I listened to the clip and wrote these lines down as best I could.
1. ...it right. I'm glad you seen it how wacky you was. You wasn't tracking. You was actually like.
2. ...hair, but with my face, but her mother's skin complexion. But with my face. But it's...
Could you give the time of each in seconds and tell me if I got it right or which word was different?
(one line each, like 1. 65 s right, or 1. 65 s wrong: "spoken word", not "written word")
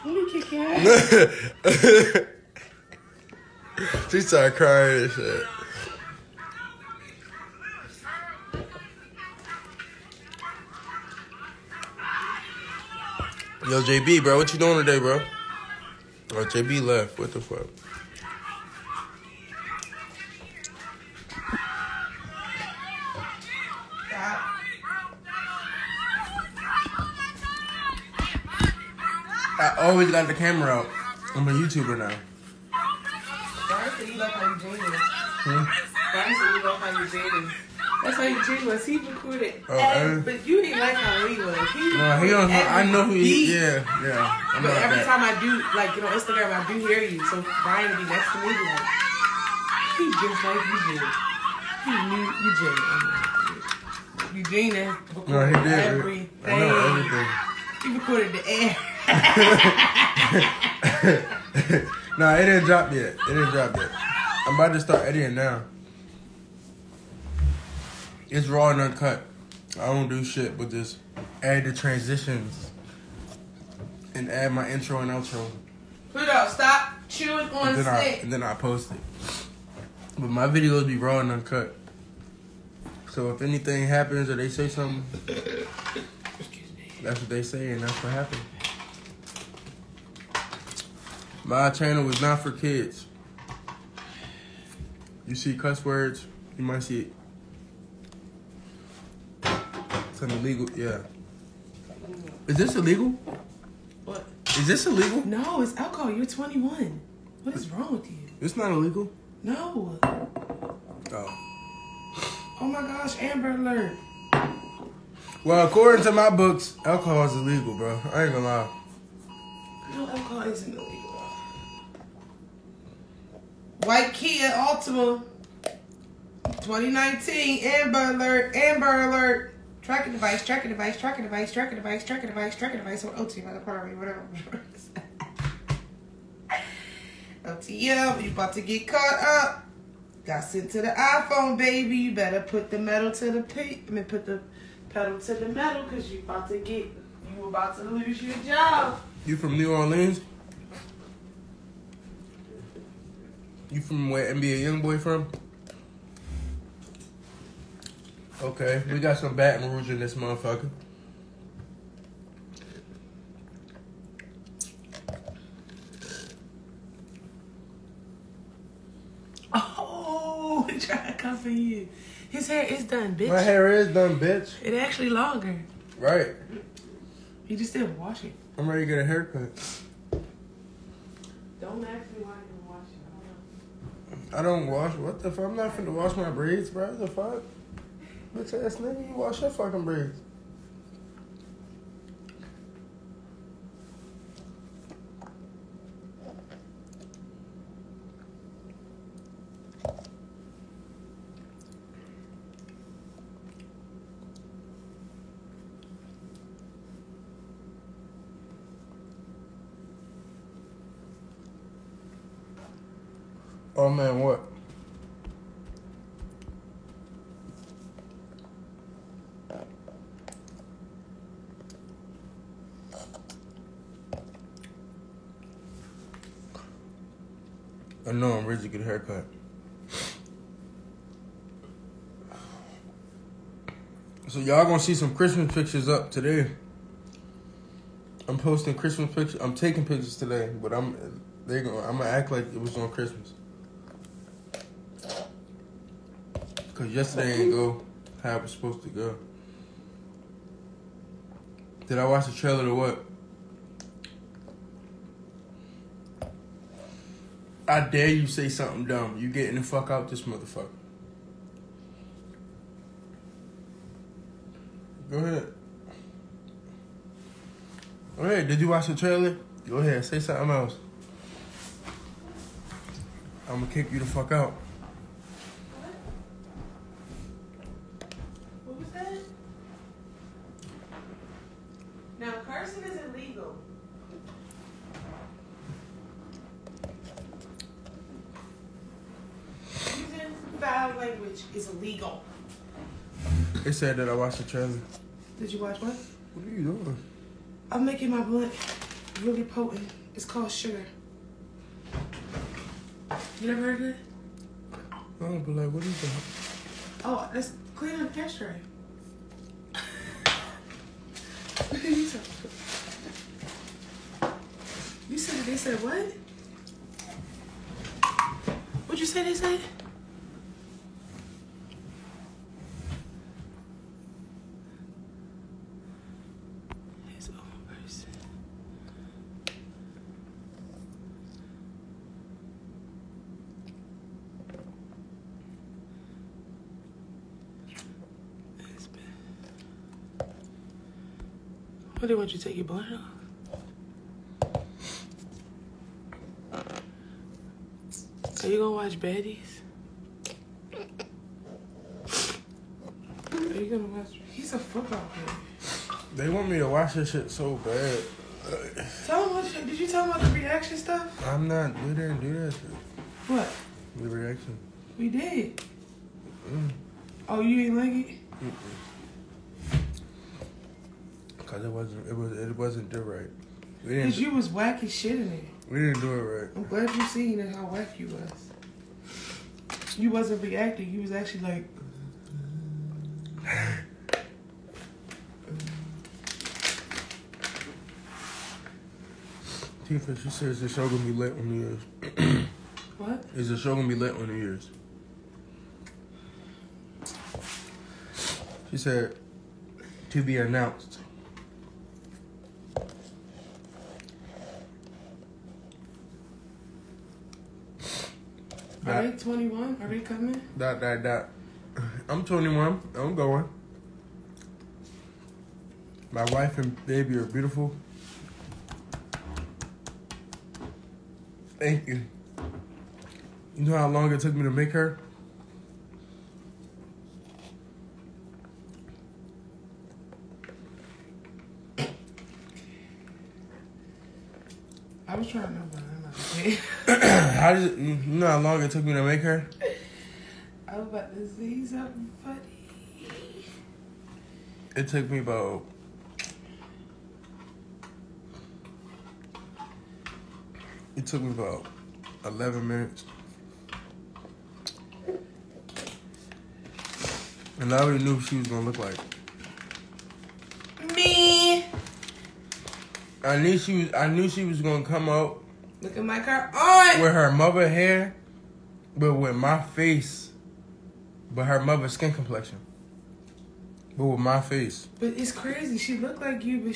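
1. 376 s wrong: "reacting", not "tracking"
2. 467 s right.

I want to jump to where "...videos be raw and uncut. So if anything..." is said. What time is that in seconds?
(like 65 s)
80 s.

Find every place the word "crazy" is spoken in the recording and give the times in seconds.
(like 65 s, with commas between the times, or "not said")
475 s.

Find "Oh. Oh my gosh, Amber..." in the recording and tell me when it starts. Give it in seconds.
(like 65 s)
111 s.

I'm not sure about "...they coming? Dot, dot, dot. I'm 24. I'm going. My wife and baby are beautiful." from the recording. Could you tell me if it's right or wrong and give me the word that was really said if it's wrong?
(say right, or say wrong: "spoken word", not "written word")
wrong: "21", not "24".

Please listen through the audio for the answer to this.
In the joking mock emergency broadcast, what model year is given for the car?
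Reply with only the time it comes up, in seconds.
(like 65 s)
126 s.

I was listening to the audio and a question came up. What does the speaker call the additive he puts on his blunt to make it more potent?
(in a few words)
sugar.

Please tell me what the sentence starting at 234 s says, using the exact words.
So y'all gonna see some Christmas pictures up today.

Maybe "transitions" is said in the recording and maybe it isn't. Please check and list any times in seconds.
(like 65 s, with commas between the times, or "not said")
71 s.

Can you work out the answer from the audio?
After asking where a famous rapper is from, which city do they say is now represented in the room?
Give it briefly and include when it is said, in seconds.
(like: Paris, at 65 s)
Baton Rouge, at 159 s.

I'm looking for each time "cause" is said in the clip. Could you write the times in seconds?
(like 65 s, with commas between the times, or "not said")
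145 s, 246 s, 374 s.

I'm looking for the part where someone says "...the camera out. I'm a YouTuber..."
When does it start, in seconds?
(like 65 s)
30 s.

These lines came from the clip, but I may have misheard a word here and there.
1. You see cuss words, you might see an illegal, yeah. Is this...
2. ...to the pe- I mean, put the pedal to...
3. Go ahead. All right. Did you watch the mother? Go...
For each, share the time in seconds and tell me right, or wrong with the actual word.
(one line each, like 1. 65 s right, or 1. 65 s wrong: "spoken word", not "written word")
1. 95 s right
2. 143 s right
3. 265 s wrong: "trailer", not "mother".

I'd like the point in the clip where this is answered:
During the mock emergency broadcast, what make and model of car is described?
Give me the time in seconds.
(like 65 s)
123 s.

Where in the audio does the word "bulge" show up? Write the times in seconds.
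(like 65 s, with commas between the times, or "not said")
not said.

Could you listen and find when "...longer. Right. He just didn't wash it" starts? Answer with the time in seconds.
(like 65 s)
175 s.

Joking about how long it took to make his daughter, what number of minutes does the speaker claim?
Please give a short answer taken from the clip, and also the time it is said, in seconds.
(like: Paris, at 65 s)
11, at 452 s.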